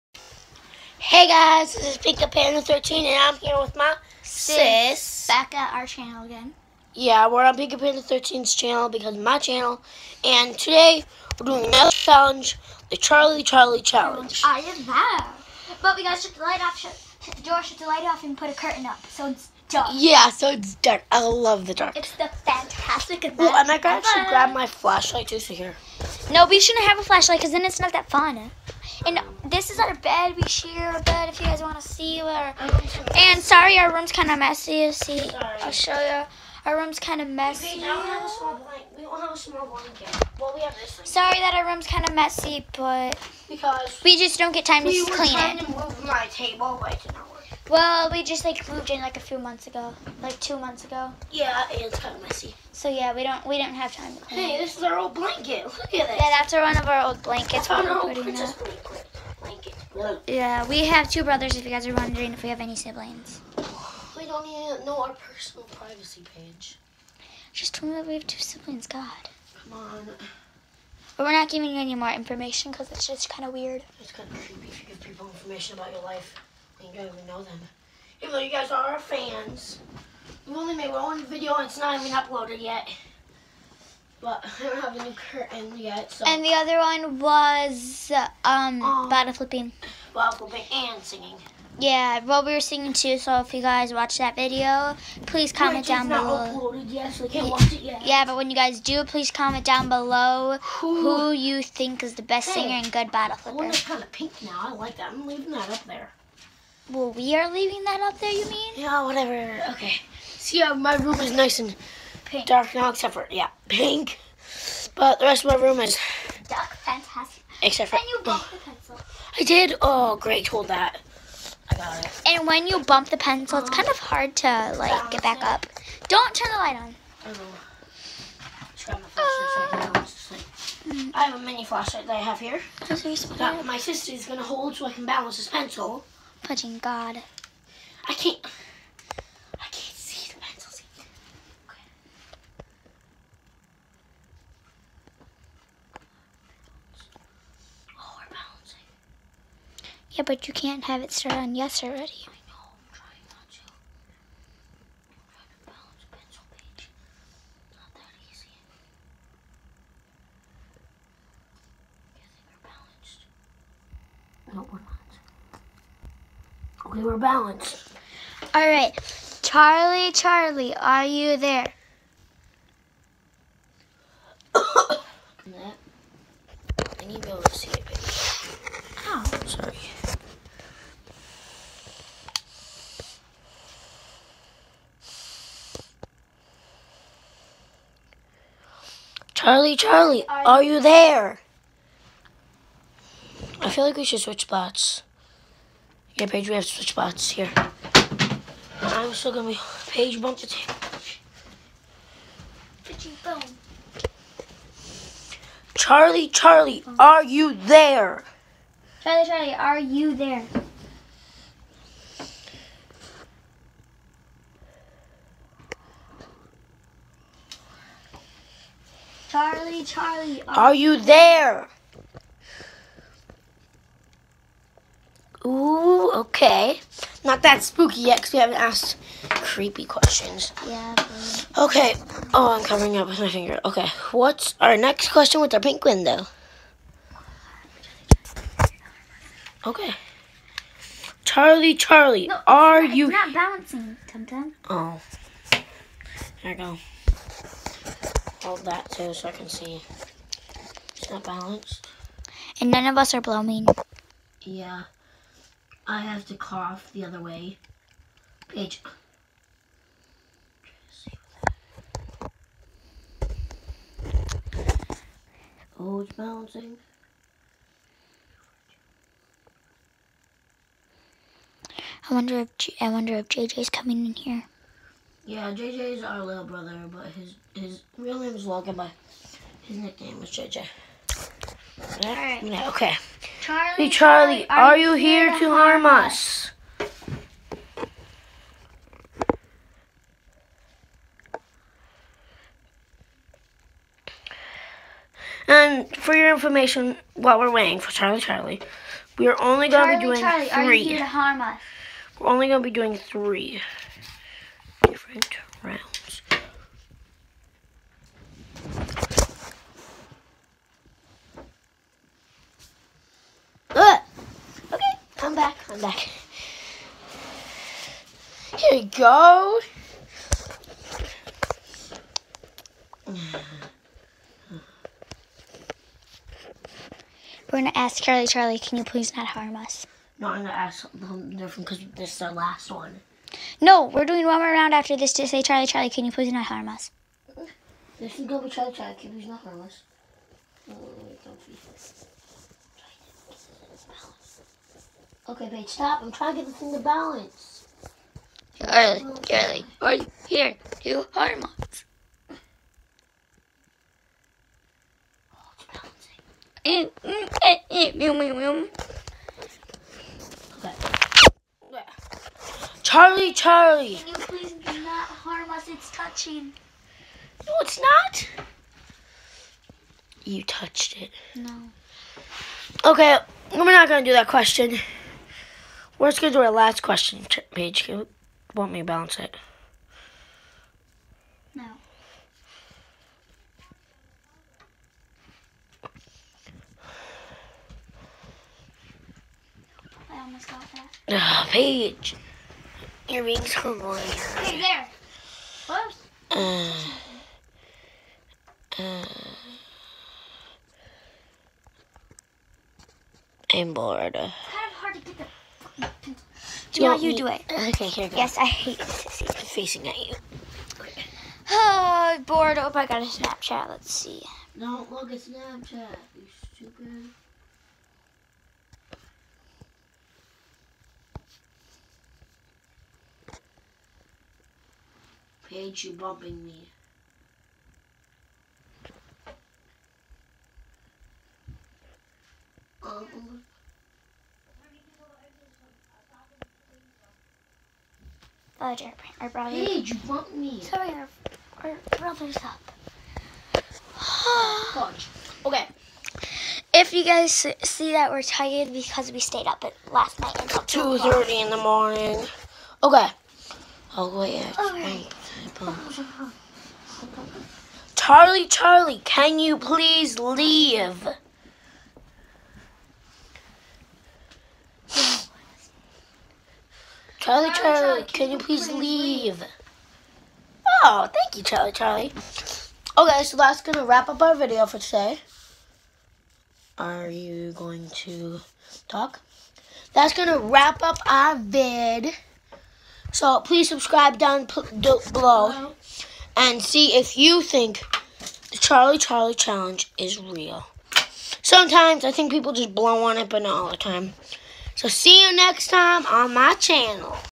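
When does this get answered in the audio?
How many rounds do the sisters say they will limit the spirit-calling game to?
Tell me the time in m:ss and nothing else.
5:02.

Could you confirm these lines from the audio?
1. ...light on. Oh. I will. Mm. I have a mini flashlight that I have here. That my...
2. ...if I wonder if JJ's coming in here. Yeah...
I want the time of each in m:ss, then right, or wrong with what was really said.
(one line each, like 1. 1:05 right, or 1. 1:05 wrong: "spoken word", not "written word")
1. 2:06 right
2. 4:32 right.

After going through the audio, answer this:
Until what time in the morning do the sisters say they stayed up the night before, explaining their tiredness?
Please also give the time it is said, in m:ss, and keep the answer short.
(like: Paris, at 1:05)
2:30, at 7:30.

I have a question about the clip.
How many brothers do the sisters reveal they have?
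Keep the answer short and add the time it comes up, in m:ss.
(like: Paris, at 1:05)
2, at 1:01.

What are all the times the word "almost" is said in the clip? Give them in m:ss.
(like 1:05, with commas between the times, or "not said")
6:30.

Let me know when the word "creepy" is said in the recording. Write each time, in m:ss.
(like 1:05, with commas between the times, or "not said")
1:14, 3:49.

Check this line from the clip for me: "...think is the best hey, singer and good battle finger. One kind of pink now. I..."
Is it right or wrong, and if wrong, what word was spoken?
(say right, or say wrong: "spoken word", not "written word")
wrong: "flipper", not "finger".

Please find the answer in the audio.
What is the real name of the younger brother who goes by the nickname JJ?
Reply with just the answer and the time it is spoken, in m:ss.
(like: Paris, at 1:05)
Logan, at 4:38.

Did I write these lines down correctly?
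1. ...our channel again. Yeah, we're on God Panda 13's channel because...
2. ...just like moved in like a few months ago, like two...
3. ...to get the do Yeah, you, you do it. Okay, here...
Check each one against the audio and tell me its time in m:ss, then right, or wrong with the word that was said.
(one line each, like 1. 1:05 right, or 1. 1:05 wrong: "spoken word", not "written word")
1. 0:05 wrong: "Pinka", not "God"
2. 0:48 right
3. 6:44 right.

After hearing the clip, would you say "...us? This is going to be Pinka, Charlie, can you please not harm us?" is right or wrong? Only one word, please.
wrong.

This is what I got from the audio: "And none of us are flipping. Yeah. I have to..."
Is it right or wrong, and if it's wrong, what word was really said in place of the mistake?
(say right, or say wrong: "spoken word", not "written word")
wrong: "blooming", not "flipping".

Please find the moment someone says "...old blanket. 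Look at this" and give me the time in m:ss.
0:54.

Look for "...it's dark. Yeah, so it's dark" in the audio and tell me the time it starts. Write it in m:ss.
0:19.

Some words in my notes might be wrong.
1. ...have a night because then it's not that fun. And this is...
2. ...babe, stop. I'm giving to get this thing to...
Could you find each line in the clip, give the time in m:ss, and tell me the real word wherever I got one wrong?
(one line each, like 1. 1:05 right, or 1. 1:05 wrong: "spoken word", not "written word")
1. 0:26 wrong: "flashlight", not "night"
2. 5:45 wrong: "trying", not "giving".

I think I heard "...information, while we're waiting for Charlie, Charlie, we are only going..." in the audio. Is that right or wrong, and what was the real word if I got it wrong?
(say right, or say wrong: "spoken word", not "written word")
right.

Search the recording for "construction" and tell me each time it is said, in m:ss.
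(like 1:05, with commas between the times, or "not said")
not said.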